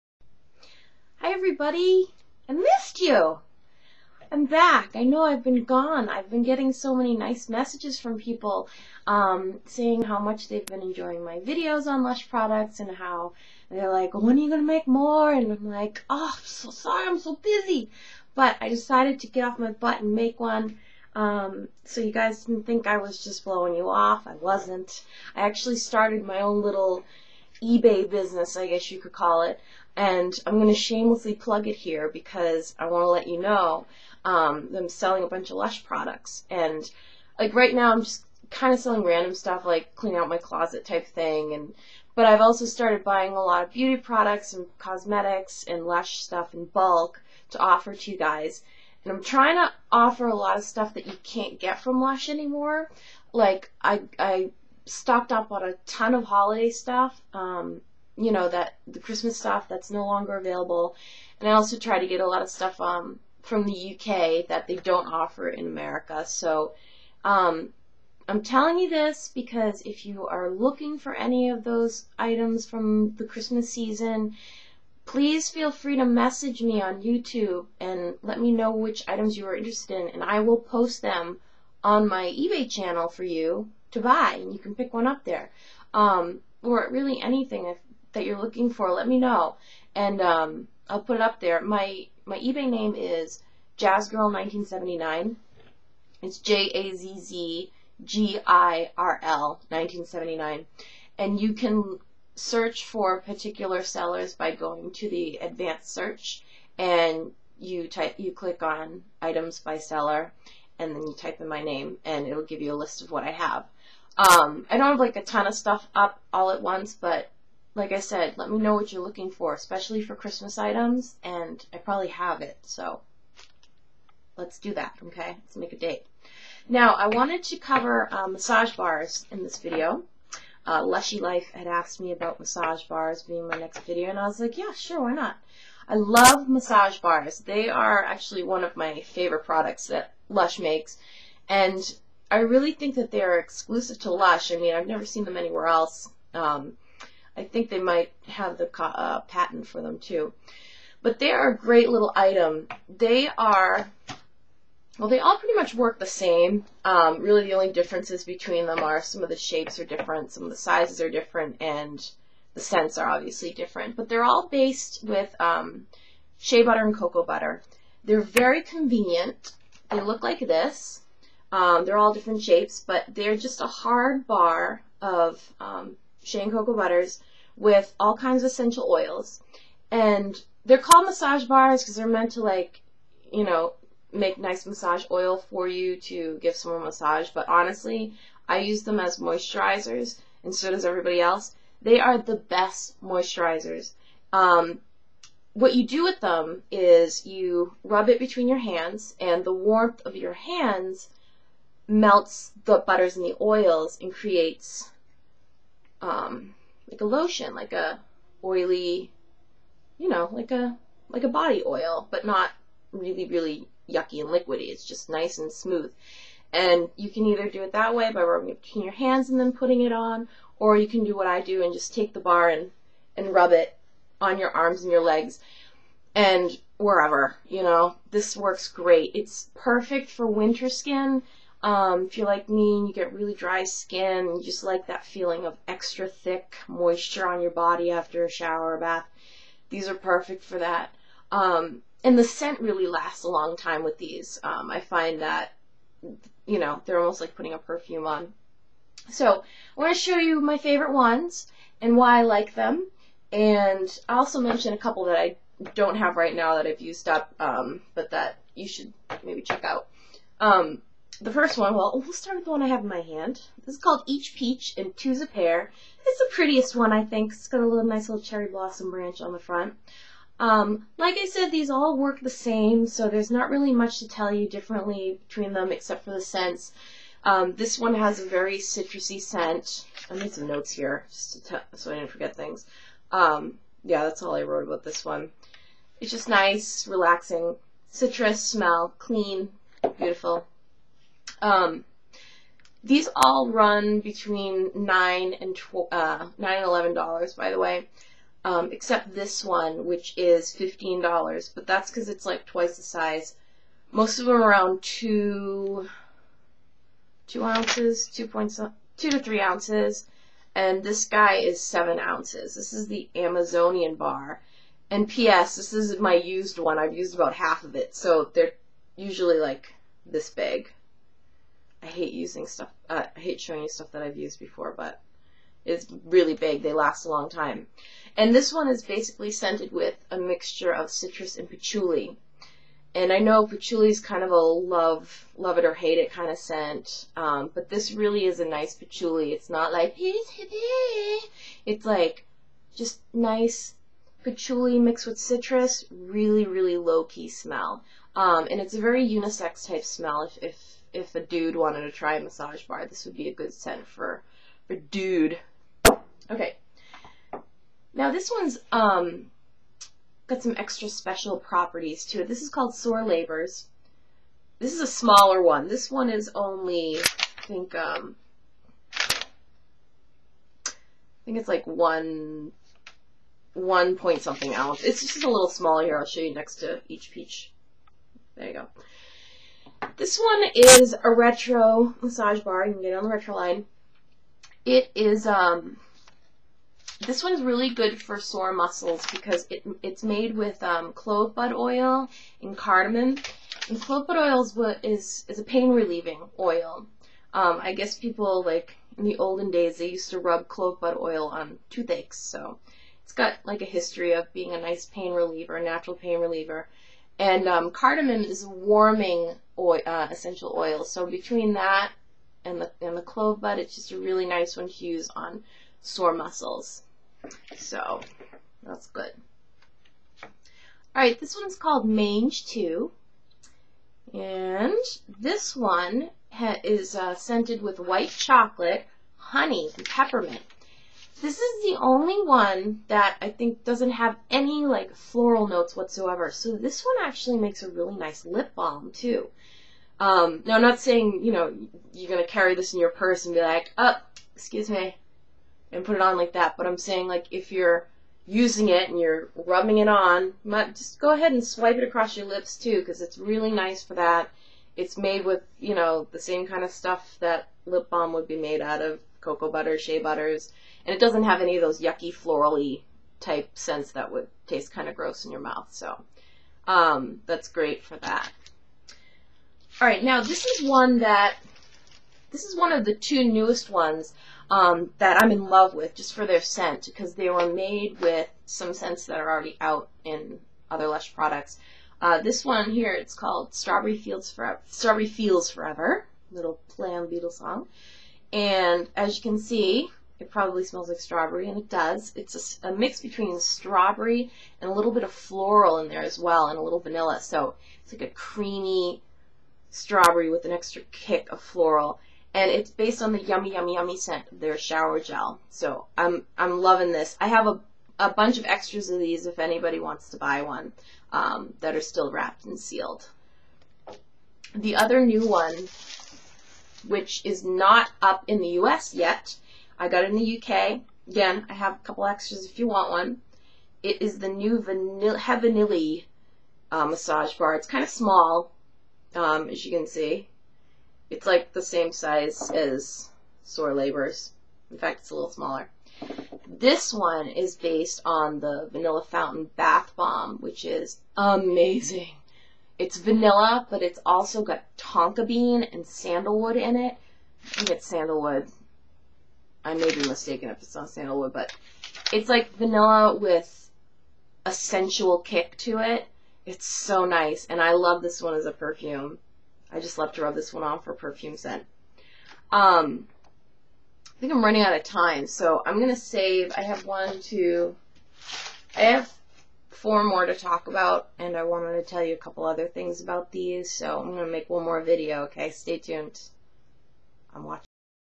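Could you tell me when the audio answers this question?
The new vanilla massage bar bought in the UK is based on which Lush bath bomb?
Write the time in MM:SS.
08:58.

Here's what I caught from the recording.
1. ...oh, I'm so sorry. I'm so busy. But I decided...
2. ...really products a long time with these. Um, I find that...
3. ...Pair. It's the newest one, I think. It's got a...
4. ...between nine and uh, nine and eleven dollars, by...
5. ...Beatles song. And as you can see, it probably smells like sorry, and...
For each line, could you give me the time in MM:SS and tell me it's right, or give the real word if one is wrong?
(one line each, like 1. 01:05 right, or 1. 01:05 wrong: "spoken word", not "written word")
1. 00:16 right
2. 04:02 wrong: "lasts", not "products"
3. 04:25 wrong: "prettiest", not "newest"
4. 04:53 right
5. 08:07 wrong: "strawberry", not "sorry".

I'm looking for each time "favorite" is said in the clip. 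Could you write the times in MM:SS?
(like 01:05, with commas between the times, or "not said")
02:19, 04:10.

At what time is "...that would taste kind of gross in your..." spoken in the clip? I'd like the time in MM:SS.
07:43.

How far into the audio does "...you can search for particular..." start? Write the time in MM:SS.
01:41.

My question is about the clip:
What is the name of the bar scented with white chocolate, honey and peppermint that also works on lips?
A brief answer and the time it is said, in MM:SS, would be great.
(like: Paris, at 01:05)
Mange Tout, at 07:01.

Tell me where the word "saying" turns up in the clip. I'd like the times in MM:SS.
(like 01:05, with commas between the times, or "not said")
00:09, 07:20, 07:26.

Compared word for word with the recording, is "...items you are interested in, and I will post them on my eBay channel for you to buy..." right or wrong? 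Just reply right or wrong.
right.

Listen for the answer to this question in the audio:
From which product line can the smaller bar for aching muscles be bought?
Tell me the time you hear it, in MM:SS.
06:23.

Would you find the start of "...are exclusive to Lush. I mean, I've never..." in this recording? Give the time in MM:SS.
02:23.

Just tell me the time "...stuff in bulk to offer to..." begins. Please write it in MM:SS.
00:46.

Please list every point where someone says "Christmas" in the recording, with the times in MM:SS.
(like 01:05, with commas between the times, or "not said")
00:58, 01:13, 02:00.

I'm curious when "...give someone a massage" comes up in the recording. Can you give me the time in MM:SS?
03:06.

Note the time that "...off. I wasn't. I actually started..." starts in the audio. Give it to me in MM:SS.
00:23.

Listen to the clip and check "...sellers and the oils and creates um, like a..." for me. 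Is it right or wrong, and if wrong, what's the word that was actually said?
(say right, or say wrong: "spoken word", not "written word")
wrong: "butters", not "sellers".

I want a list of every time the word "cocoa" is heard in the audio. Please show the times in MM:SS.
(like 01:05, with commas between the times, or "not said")
02:46, 02:56, 07:39.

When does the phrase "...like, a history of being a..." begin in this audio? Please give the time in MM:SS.
06:43.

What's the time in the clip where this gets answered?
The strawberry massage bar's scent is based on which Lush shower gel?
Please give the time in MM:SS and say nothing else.
08:23.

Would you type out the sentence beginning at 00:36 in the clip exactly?
And like right now, I'm just kind of selling random stuff like clean out my closet type thing.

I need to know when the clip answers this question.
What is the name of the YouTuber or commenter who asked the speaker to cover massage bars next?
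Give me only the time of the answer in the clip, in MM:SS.
02:10.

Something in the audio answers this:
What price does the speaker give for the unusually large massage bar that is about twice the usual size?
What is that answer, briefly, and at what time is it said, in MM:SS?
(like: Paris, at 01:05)
$15, at 05:00.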